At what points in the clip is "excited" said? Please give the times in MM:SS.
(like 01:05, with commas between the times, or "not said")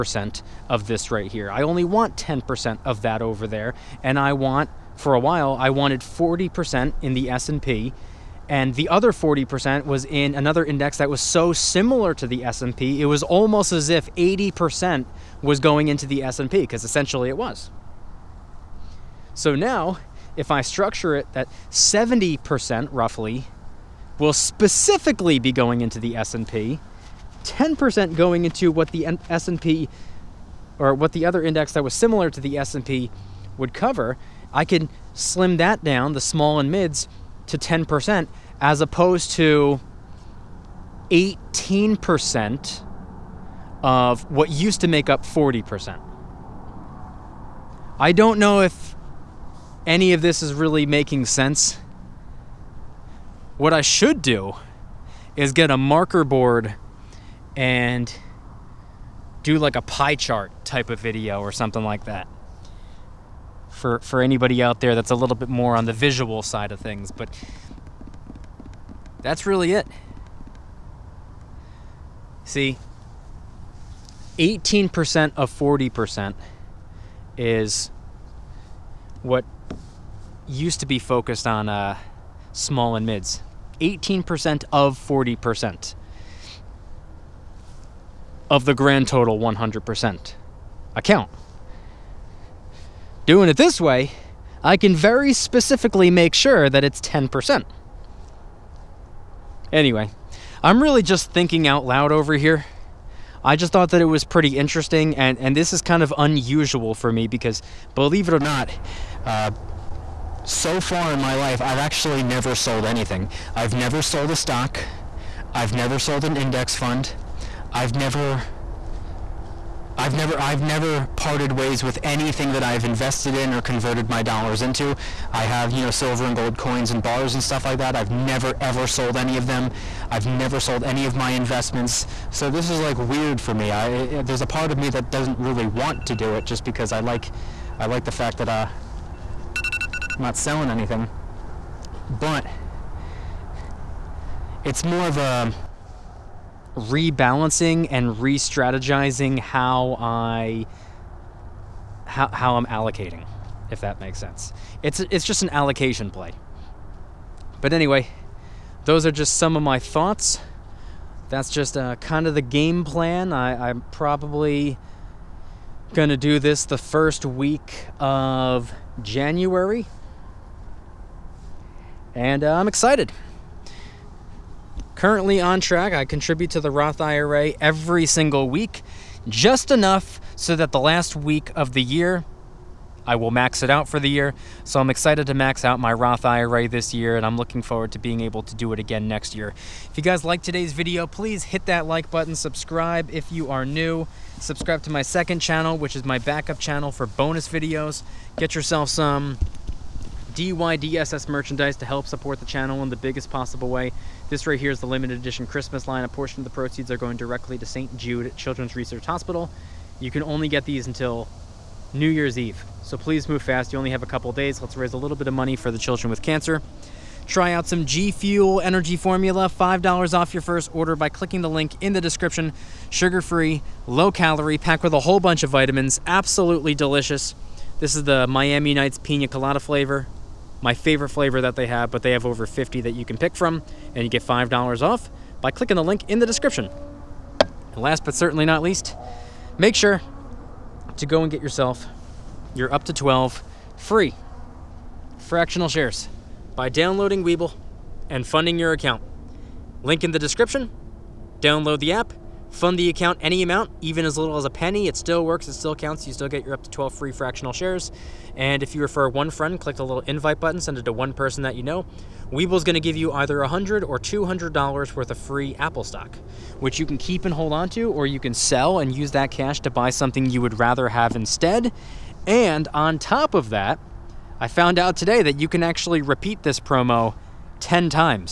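02:52, 03:04.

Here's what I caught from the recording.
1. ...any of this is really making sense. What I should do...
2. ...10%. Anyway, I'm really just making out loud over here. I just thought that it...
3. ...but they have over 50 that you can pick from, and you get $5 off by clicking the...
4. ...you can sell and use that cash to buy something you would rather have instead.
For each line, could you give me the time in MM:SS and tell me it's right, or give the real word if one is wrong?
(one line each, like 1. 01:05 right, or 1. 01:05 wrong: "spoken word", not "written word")
1. 00:49 right
2. 01:36 wrong: "thinking", not "making"
3. 03:51 right
4. 04:28 right.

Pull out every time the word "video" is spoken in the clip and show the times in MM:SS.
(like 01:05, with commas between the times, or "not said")
01:00, 03:10, 03:17.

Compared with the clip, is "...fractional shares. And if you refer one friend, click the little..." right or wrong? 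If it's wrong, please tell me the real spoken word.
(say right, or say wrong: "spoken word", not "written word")
right.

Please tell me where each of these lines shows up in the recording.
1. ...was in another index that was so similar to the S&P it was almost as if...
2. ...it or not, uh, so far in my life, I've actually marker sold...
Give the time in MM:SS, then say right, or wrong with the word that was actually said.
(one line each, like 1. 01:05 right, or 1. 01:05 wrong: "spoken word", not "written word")
1. 00:09 right
2. 01:48 wrong: "never", not "marker".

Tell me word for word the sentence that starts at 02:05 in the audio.
I have, you know, silver and gold coins and bars and stuff like that.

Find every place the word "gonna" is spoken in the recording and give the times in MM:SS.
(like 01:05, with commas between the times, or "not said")
02:45.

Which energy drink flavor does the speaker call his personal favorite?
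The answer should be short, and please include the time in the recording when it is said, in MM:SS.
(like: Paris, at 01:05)
Miami Nights Pina Colada, at 03:48.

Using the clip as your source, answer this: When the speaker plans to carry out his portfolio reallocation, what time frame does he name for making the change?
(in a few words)
First week of January.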